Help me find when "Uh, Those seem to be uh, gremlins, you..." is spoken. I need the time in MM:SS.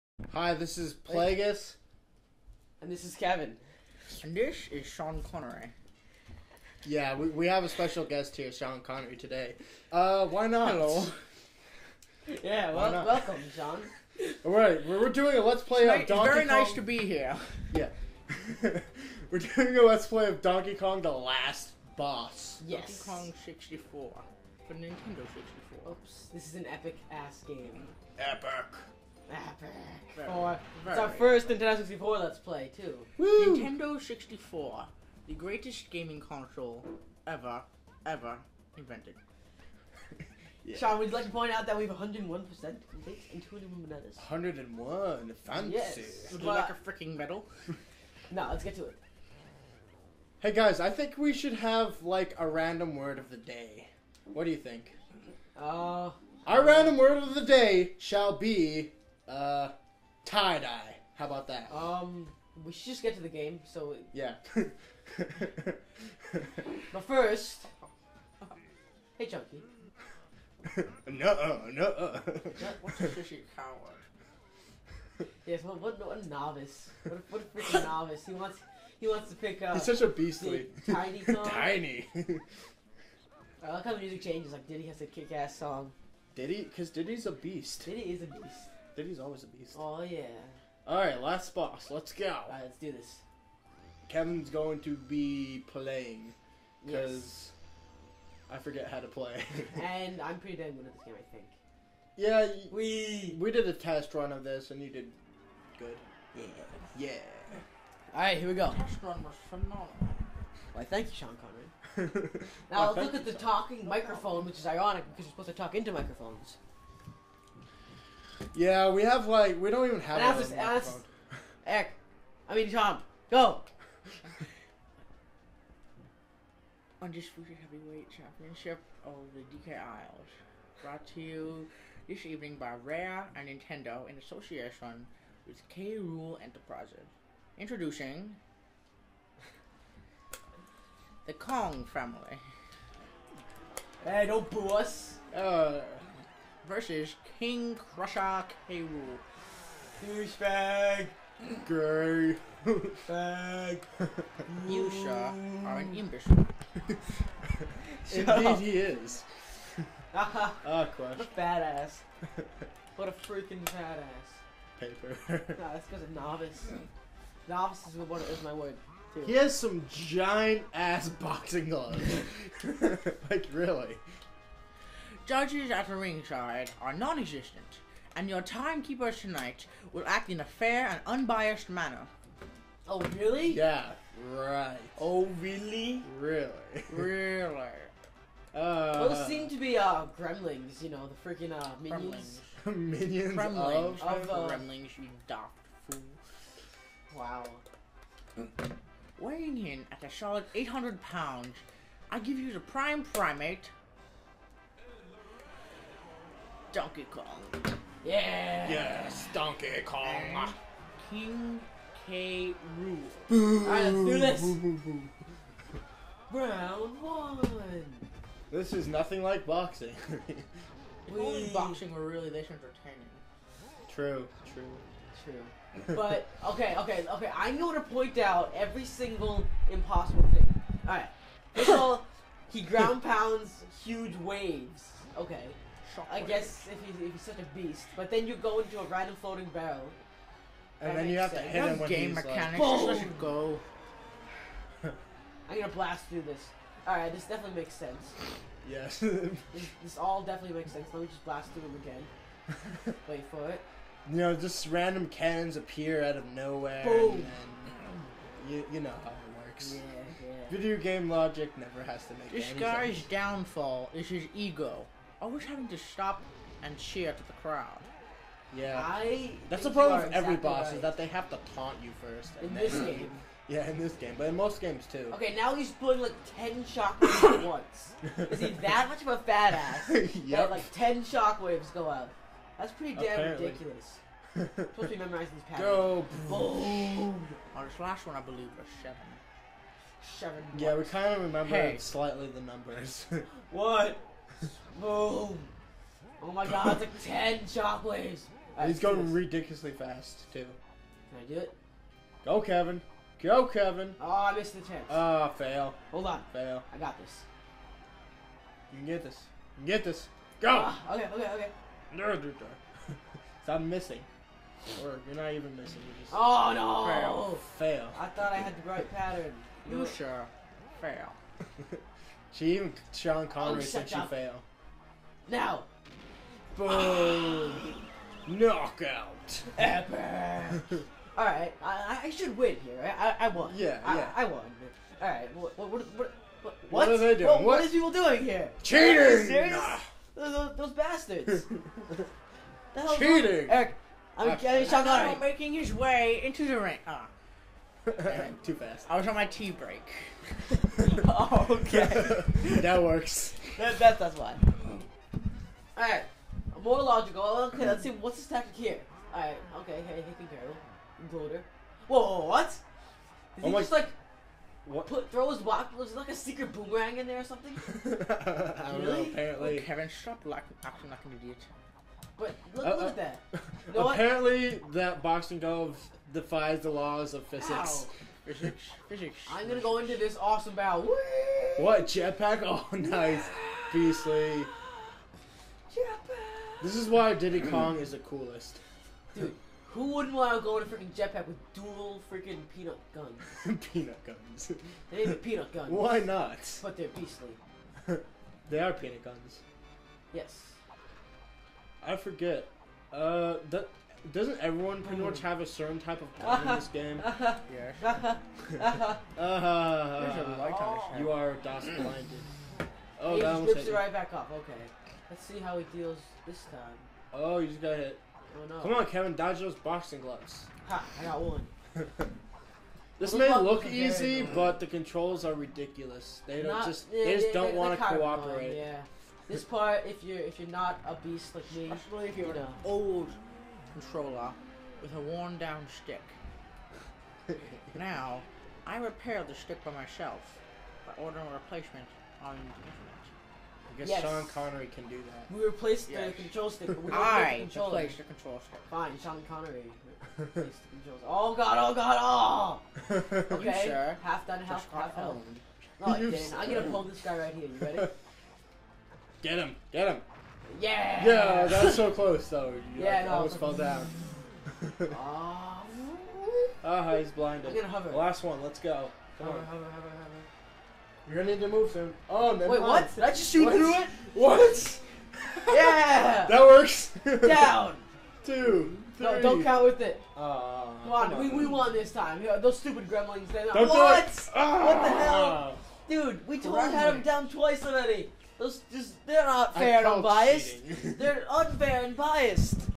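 03:08.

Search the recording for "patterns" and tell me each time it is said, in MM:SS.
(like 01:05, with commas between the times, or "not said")
04:45, 05:18.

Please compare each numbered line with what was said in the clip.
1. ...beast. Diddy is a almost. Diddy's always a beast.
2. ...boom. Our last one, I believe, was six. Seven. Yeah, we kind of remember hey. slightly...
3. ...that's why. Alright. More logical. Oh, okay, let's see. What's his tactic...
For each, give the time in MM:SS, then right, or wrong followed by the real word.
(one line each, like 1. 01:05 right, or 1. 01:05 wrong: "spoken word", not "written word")
1. 01:27 wrong: "beast", not "almost"
2. 04:46 wrong: "seven", not "six"
3. 05:53 right.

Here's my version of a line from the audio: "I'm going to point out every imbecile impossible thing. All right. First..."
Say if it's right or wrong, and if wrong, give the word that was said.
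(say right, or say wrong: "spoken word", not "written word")
wrong: "single", not "imbecile".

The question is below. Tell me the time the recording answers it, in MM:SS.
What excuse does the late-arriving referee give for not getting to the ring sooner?
05:49.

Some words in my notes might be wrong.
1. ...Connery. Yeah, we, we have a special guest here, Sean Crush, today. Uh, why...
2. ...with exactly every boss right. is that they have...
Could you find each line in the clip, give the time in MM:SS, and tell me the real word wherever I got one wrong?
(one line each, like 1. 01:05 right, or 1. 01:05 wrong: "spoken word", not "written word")
1. 00:05 wrong: "Connery", not "Crush"
2. 04:29 right.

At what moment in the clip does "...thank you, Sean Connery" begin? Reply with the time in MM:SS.
01:50.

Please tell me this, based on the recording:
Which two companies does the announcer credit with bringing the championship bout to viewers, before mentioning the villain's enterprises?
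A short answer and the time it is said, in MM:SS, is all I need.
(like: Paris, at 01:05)
Rare and Nintendo, at 02:12.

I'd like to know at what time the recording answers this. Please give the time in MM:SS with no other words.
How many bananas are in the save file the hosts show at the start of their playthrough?
00:43.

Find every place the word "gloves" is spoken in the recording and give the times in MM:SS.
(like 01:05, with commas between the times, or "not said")
02:51, 06:15, 07:00.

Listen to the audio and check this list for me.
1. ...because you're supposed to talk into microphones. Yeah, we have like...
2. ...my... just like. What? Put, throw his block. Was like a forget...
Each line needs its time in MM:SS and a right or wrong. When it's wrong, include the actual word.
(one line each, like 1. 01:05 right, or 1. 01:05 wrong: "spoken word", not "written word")
1. 01:55 right
2. 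06:03 wrong: "secret", not "forget".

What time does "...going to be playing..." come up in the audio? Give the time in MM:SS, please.
01:34.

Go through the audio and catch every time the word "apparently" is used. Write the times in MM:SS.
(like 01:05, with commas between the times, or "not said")
04:43, 06:09, 06:13.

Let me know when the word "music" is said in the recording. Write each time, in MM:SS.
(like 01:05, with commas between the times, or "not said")
01:23.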